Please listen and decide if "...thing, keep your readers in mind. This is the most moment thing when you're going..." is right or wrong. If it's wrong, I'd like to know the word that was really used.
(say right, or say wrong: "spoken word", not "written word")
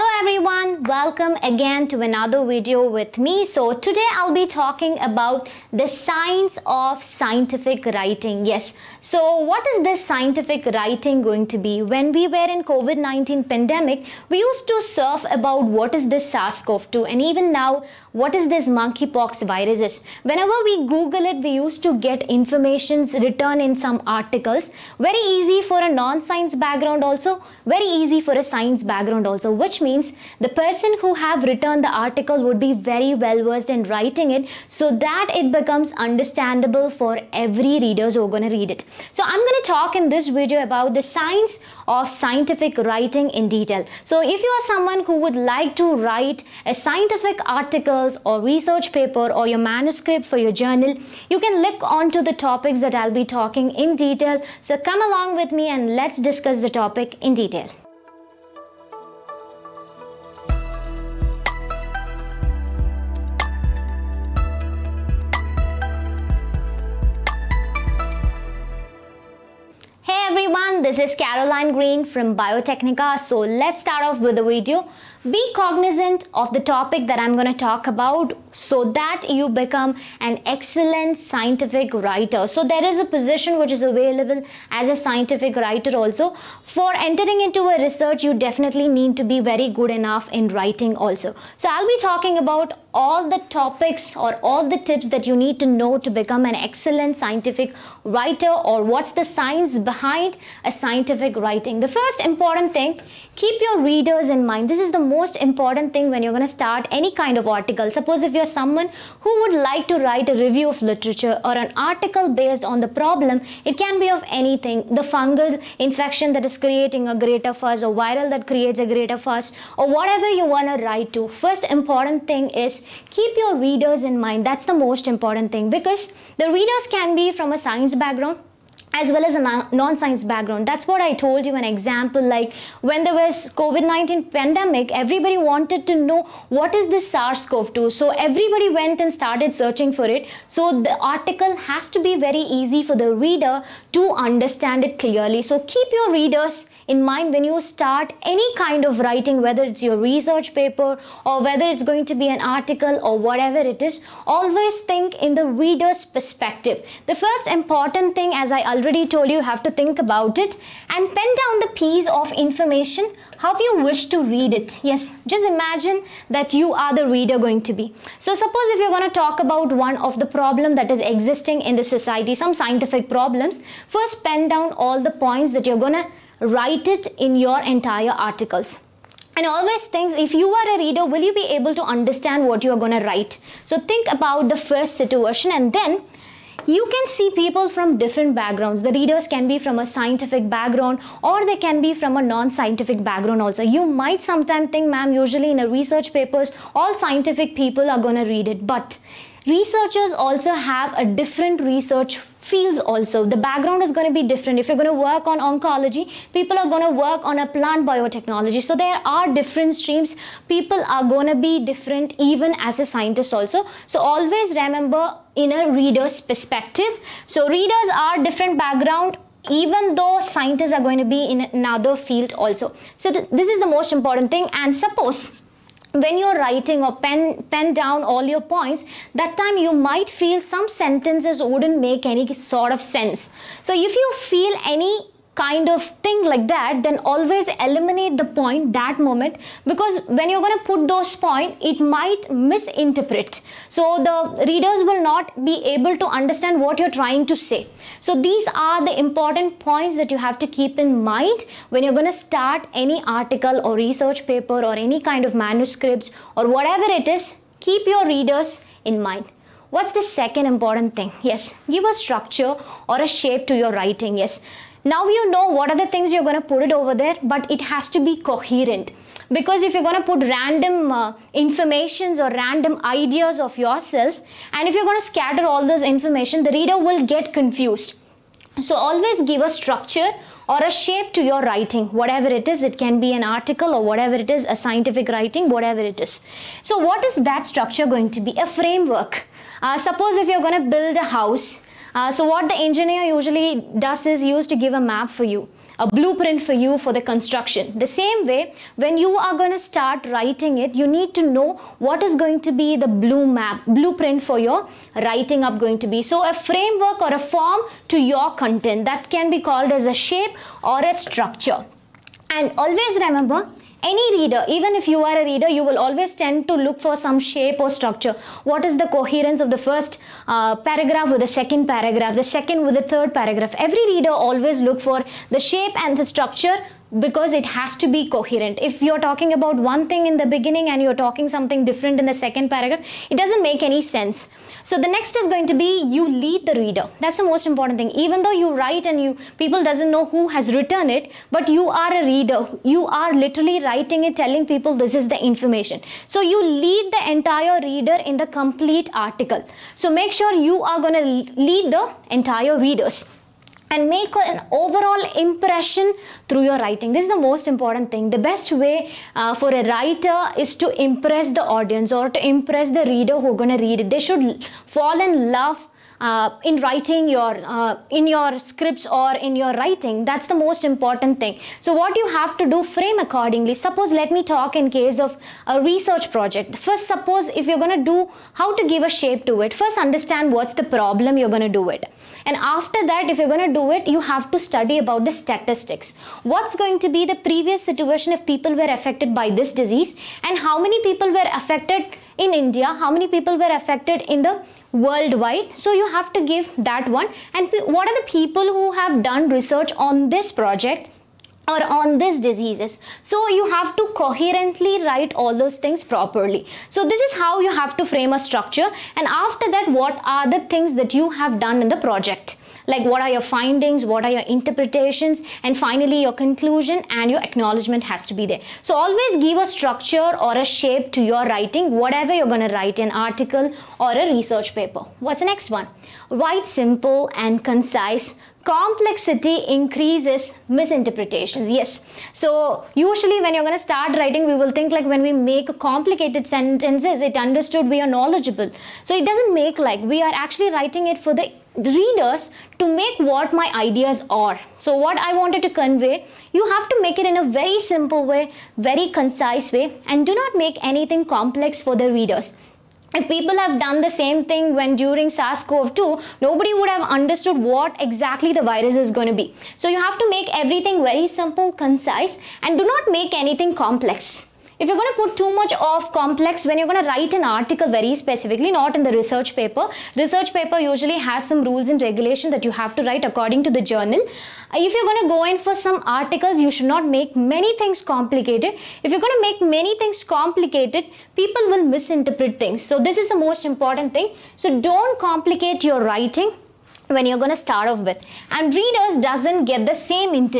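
wrong: "important", not "moment".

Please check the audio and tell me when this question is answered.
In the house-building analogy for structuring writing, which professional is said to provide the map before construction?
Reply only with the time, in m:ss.
4:52.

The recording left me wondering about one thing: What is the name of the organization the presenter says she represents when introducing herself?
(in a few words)
Biotecnika.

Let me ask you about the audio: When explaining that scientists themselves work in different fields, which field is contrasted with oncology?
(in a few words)
plant biotechnology.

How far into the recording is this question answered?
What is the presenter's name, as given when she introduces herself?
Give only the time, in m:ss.
1:11.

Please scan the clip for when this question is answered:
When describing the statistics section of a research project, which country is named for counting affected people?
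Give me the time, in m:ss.
6:32.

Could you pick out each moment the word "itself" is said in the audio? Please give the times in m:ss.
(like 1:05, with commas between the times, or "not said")
not said.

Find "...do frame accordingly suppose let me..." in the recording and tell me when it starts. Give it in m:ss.
6:12.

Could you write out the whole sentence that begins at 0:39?
So I'm going to talk in this video about the science of scientific writing in detail.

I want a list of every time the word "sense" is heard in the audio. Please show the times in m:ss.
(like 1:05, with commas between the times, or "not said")
3:52, 5:33.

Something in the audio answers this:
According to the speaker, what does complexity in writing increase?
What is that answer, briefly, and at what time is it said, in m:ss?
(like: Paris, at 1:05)
misinterpretations, at 7:10.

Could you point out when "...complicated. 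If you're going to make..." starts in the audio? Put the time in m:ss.
7:57.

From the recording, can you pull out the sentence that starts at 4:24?
Yes, now you know what are the things you're going to put it over there, but it has to be coherent.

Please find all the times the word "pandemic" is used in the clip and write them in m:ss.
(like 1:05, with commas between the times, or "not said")
0:13, 2:14.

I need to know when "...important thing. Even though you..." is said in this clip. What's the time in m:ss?
5:37.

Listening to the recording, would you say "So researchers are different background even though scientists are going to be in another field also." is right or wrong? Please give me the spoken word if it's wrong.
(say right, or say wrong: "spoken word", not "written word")
wrong: "readers", not "researchers".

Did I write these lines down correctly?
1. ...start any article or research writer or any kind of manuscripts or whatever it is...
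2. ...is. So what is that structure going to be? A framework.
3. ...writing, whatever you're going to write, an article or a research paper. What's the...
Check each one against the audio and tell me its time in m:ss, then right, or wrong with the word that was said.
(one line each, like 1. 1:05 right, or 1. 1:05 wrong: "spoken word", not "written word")
1. 4:12 wrong: "paper", not "writer"
2. 4:46 right
3. 7:01 right.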